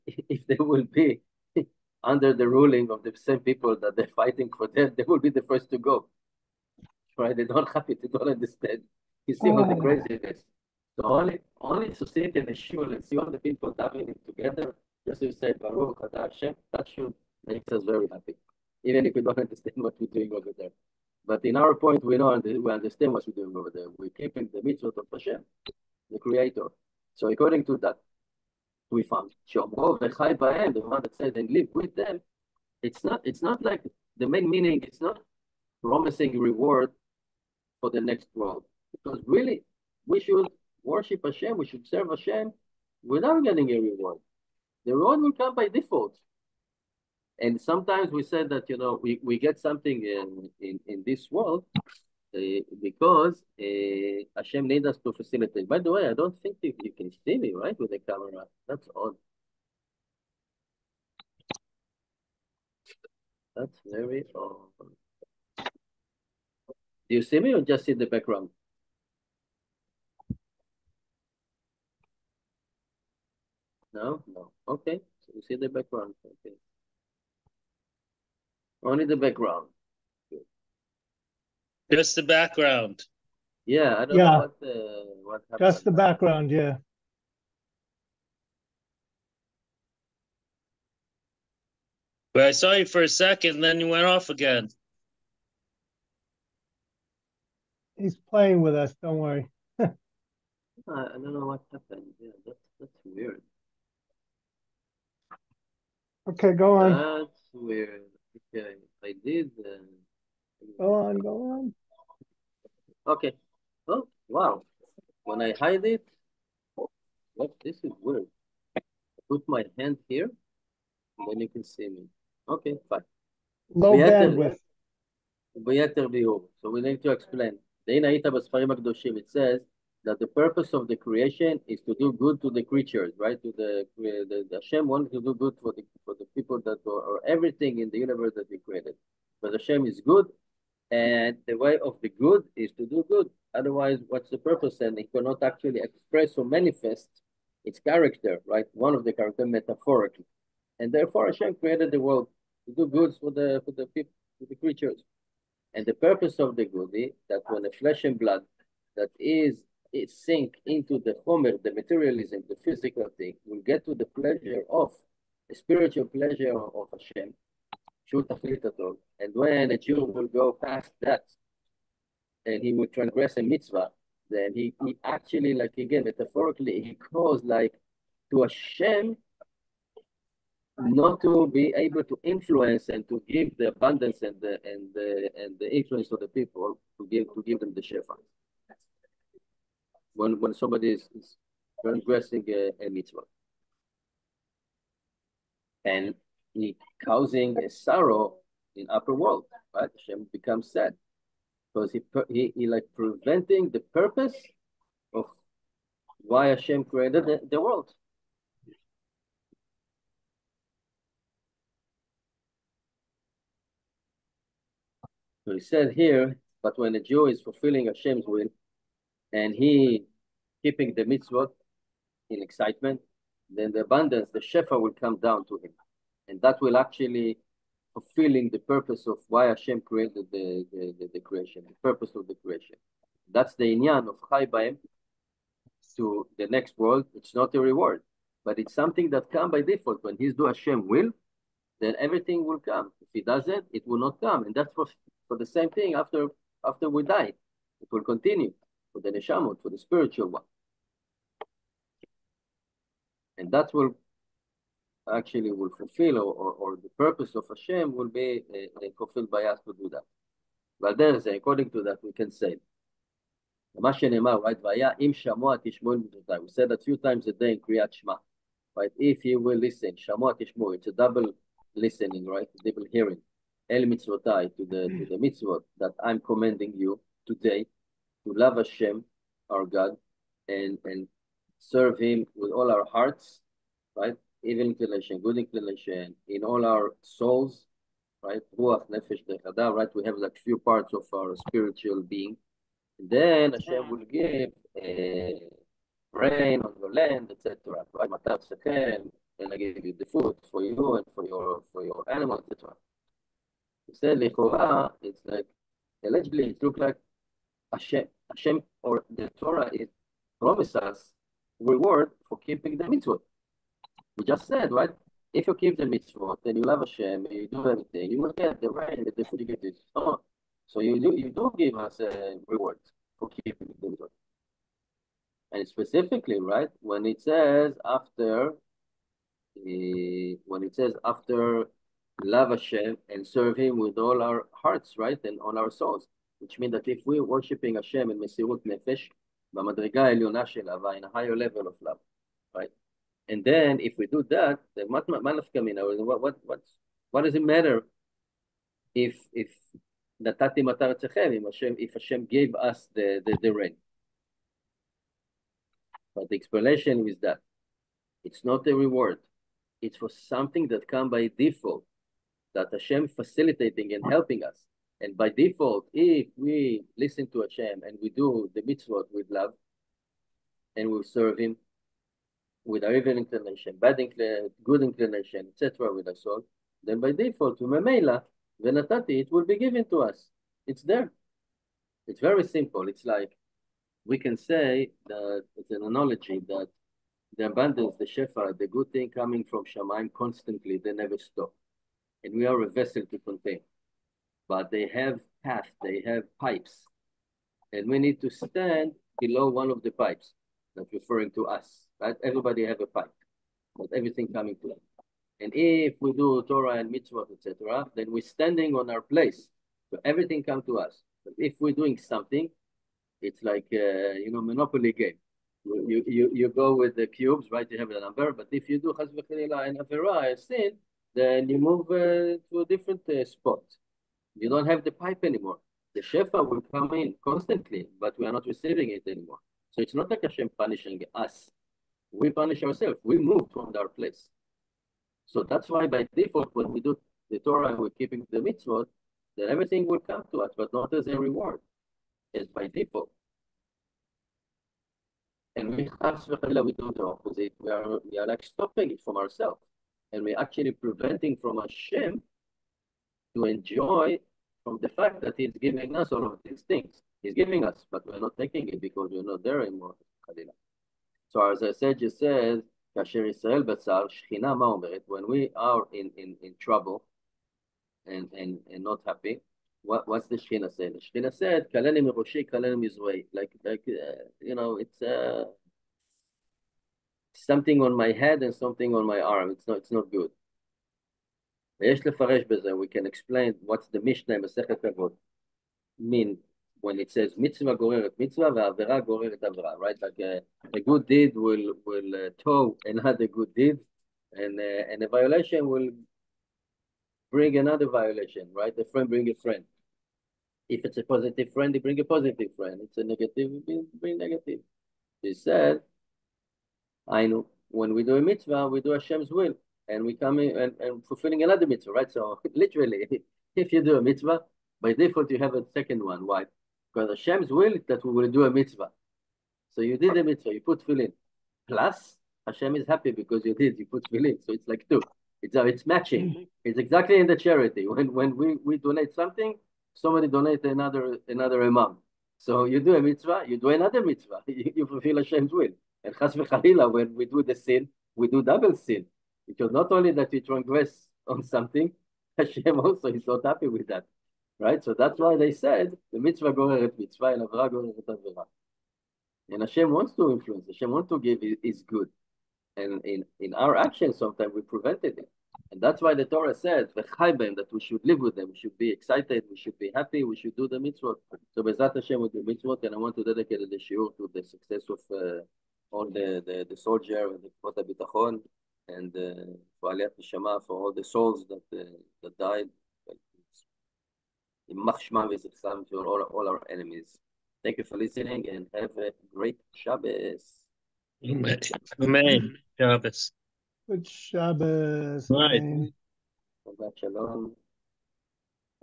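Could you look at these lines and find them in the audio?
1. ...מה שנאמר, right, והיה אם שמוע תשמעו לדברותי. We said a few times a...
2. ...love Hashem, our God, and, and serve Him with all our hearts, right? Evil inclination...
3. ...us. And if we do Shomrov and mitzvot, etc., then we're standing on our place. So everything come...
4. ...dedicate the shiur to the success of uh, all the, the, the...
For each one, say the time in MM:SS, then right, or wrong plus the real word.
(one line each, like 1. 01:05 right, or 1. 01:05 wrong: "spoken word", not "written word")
1. 04:23 right
2. 04:38 right
3. 06:44 wrong: "Torah", not "Shomrov"
4. 09:23 right.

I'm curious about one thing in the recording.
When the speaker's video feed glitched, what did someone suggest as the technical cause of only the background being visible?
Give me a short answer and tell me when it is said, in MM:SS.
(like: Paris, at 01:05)
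Low bandwidth, at 02:03.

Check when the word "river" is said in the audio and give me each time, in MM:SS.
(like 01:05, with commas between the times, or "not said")
not said.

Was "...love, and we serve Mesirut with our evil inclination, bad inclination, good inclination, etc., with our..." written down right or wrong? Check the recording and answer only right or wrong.
wrong.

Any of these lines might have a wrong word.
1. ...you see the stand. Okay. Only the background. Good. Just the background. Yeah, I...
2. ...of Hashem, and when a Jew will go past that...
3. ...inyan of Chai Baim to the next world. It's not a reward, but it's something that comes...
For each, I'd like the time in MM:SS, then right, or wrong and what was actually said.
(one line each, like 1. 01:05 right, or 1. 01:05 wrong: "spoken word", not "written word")
1. 01:15 wrong: "background", not "stand"
2. 02:46 right
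3. 03:53 right.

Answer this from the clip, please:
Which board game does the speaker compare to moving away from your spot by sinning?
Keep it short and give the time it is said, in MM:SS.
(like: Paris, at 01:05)
Monopoly, at 06:54.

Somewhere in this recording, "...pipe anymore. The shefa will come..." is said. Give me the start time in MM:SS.
07:04.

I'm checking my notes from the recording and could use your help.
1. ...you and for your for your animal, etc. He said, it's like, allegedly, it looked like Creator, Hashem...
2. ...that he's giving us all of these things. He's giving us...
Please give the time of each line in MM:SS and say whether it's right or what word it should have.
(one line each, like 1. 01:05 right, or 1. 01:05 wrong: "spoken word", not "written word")
1. 05:00 wrong: "Hashem", not "Creator"
2. 07:35 right.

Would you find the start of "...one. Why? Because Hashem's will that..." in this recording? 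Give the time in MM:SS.
08:36.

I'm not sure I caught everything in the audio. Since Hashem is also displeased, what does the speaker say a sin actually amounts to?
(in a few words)
Double sin.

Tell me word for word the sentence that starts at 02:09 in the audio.
It says, that the purpose of the creation is to do good to the creatures, right?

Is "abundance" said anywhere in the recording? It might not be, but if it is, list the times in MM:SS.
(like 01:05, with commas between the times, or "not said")
03:03, 03:43, 06:27.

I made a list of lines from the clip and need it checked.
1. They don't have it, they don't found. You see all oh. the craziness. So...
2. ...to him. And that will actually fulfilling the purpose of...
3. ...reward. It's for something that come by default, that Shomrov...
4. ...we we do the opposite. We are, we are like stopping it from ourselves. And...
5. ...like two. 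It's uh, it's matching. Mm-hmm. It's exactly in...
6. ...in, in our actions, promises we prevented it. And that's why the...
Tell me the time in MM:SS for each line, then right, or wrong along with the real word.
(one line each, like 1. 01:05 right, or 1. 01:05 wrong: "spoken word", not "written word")
1. 00:07 wrong: "understand", not "found"
2. 03:45 right
3. 05:58 wrong: "Hashem", not "Shomrov"
4. 07:25 right
5. 08:44 right
6. 09:13 wrong: "sometimes", not "promises".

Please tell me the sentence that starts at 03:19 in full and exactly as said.
Hashem becomes sad because he, he he like preventing the purpose of why Hashem created the, the world.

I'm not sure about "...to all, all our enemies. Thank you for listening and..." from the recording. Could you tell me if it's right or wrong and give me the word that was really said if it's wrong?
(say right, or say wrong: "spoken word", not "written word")
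right.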